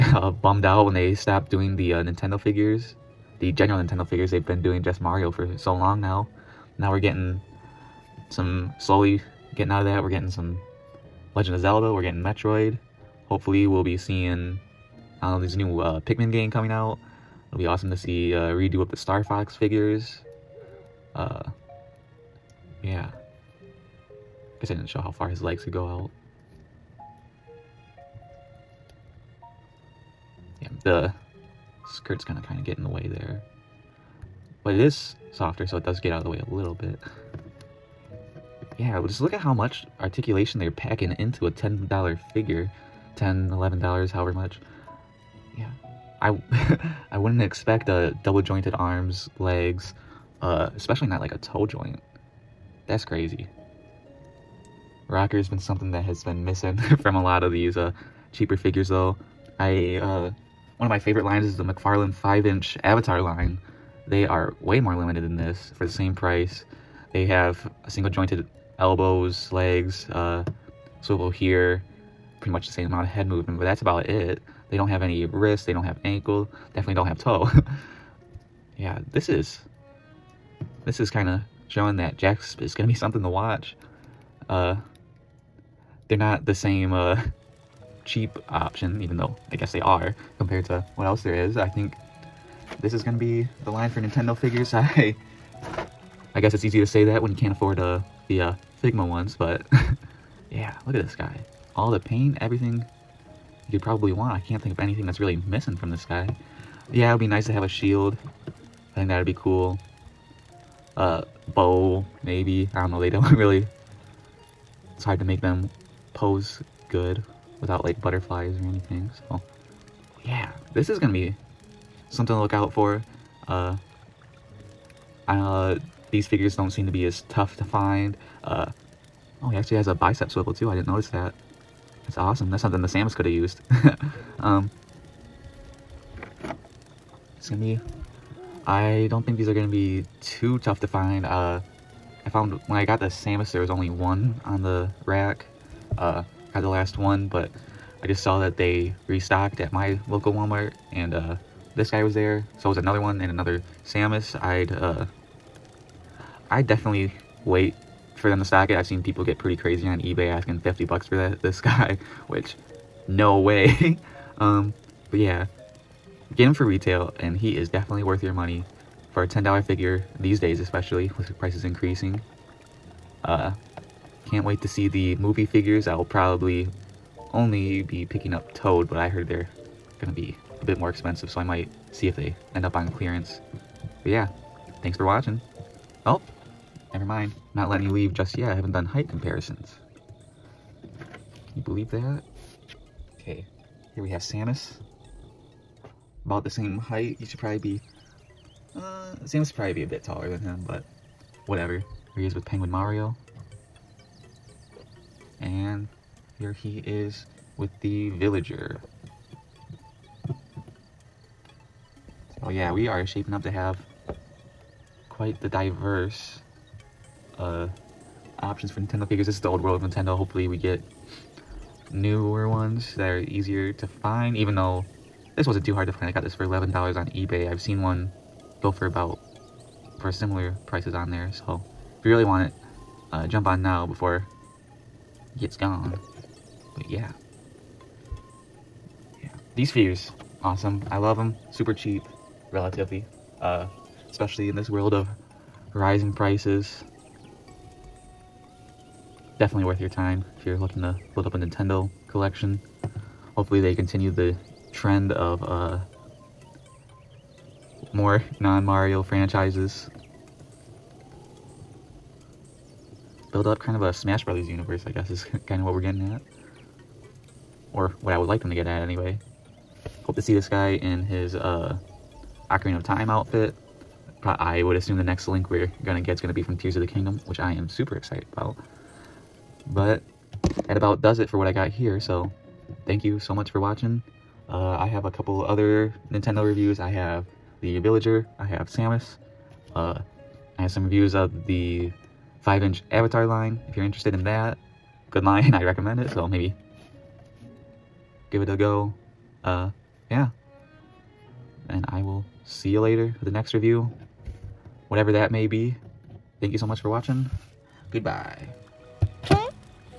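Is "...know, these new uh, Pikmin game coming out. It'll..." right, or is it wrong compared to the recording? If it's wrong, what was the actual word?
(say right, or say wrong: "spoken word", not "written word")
right.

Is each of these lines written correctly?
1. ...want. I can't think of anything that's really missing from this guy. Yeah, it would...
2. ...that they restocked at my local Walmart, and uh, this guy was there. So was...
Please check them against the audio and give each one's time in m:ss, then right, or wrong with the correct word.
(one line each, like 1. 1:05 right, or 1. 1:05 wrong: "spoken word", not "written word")
1. 1:44 right
2. 2:28 right.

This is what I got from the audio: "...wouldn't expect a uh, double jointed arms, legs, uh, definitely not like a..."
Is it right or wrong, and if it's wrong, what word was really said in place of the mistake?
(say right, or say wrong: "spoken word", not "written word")
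wrong: "especially", not "definitely".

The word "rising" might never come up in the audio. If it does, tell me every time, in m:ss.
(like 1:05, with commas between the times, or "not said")
4:05.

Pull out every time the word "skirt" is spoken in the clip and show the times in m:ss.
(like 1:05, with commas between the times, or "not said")
0:31.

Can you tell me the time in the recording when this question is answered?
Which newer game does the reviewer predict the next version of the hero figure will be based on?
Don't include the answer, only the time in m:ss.
4:36.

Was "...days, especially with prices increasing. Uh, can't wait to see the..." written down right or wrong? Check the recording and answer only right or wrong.
right.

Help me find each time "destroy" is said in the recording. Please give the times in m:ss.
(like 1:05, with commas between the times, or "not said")
not said.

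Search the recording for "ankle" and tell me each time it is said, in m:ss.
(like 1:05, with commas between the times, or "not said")
1:16.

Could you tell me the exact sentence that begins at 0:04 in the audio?
They've been doing just Mario for so long now.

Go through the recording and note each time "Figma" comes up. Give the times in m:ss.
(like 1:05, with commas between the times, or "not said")
1:38.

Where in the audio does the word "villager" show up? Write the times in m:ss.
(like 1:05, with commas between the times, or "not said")
3:28, 4:47.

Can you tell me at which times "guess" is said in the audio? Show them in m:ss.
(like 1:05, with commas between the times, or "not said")
0:24, 1:29, 1:36, 4:24.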